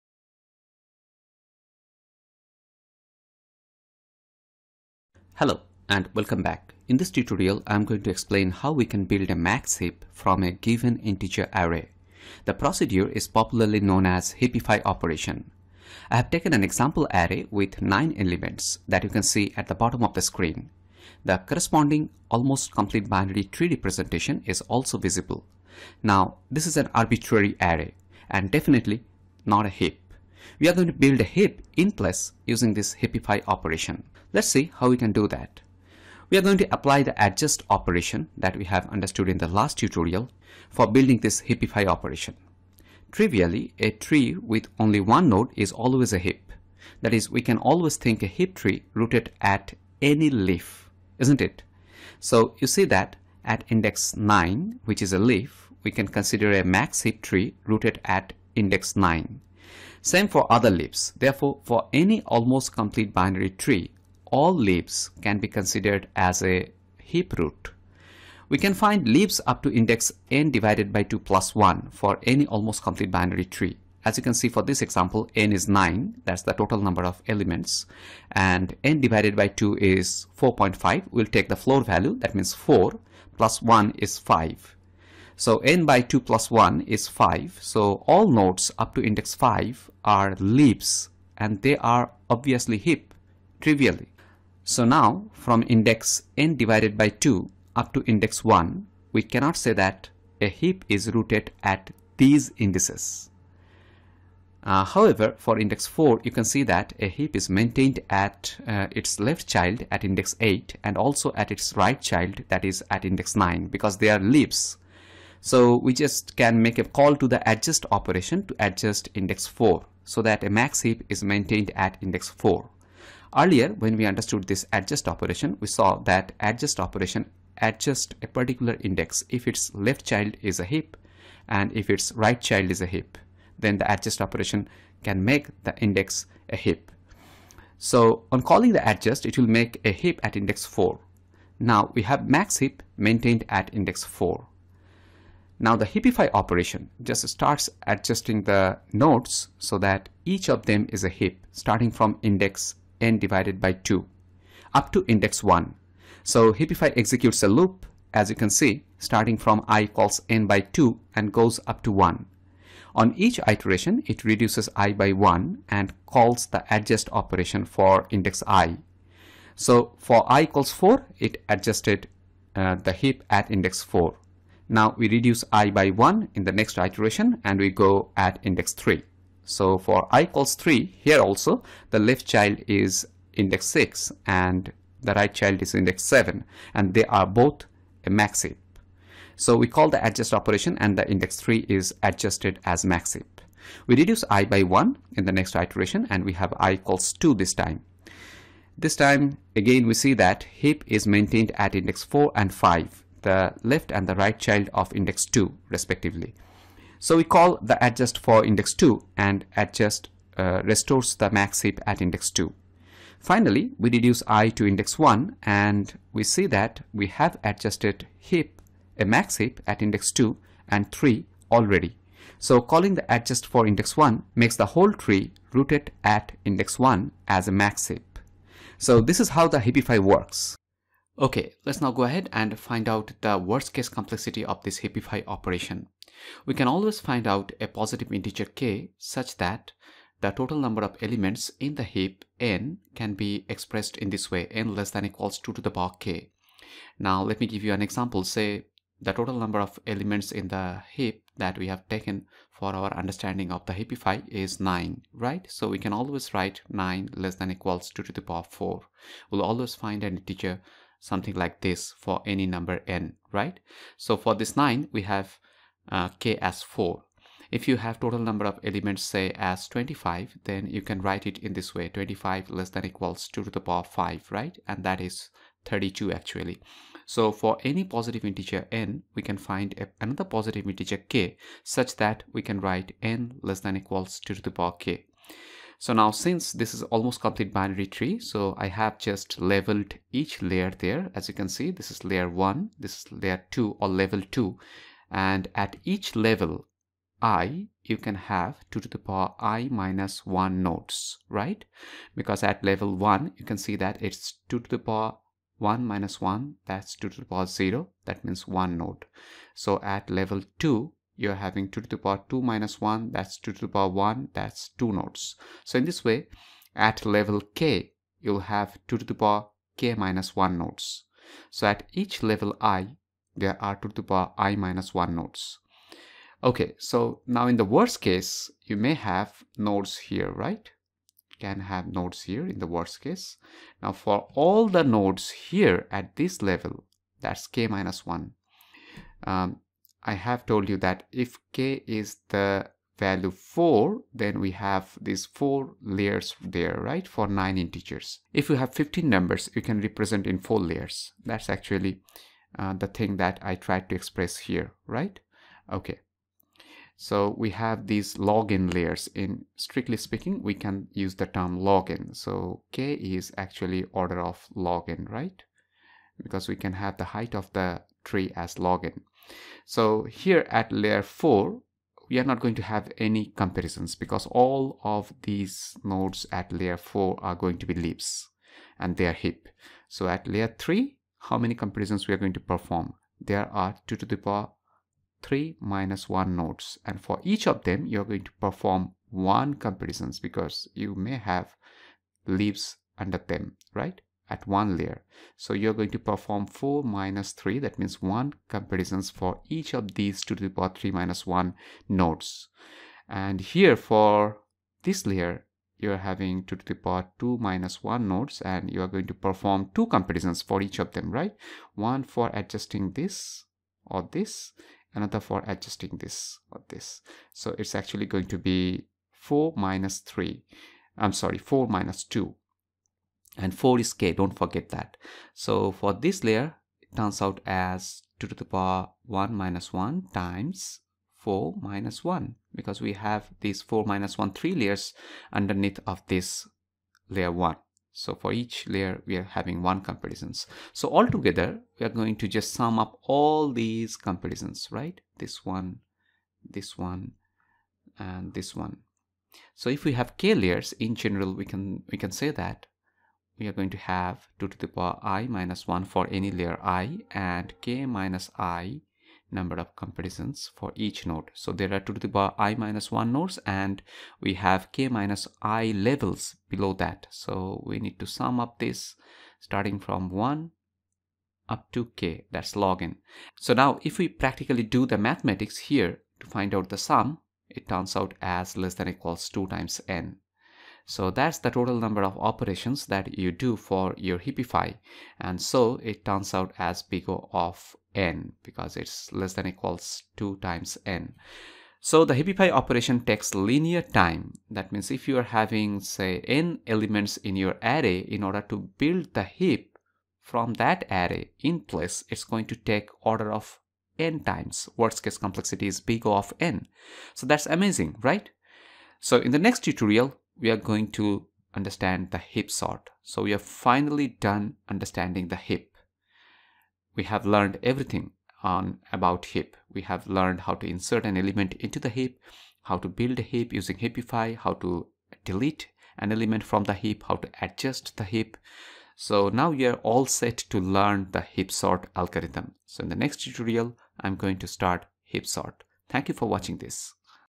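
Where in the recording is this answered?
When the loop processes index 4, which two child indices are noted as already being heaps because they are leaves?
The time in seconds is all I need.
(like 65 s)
110 s.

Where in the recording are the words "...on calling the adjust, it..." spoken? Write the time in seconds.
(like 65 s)
138 s.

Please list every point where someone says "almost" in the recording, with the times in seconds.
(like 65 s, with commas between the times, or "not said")
22 s, 62 s, 72 s, 286 s.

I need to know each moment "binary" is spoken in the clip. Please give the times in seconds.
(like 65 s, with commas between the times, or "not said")
23 s, 63 s, 73 s, 287 s.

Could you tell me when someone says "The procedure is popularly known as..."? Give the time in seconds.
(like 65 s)
12 s.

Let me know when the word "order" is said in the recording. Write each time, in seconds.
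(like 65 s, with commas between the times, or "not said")
363 s, 498 s, 503 s.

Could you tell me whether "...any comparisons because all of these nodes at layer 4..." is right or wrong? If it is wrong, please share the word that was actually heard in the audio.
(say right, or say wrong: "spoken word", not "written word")
right.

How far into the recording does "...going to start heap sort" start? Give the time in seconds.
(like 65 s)
534 s.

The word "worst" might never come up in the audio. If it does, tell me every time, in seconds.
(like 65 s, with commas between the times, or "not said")
233 s, 327 s, 332 s, 504 s.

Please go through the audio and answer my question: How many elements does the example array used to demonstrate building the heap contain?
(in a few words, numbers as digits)
9.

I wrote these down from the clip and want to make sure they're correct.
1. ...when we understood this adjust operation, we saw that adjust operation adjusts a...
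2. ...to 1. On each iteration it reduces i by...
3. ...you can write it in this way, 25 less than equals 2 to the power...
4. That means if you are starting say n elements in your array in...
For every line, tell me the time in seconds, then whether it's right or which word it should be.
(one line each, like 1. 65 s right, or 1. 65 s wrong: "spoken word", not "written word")
1. 123 s right
2. 161 s right
3. 270 s right
4. 494 s wrong: "having", not "starting".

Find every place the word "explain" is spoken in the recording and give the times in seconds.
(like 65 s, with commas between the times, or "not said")
8 s.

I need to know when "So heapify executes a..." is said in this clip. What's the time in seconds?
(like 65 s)
156 s.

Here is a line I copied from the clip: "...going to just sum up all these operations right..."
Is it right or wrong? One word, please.
wrong.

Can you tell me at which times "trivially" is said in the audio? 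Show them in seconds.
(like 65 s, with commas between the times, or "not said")
43 s, 93 s.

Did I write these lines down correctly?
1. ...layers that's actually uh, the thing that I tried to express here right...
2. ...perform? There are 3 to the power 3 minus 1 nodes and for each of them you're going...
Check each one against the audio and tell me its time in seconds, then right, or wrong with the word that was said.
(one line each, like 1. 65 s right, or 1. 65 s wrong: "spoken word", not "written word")
1. 350 s right
2. 382 s wrong: "2", not "3".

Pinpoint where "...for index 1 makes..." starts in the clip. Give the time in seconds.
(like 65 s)
223 s.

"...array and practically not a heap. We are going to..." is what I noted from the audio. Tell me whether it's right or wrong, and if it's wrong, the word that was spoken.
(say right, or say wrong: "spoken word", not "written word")
wrong: "definitely", not "practically".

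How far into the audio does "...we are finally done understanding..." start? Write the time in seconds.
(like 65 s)
513 s.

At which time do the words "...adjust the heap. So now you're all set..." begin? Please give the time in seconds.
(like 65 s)
527 s.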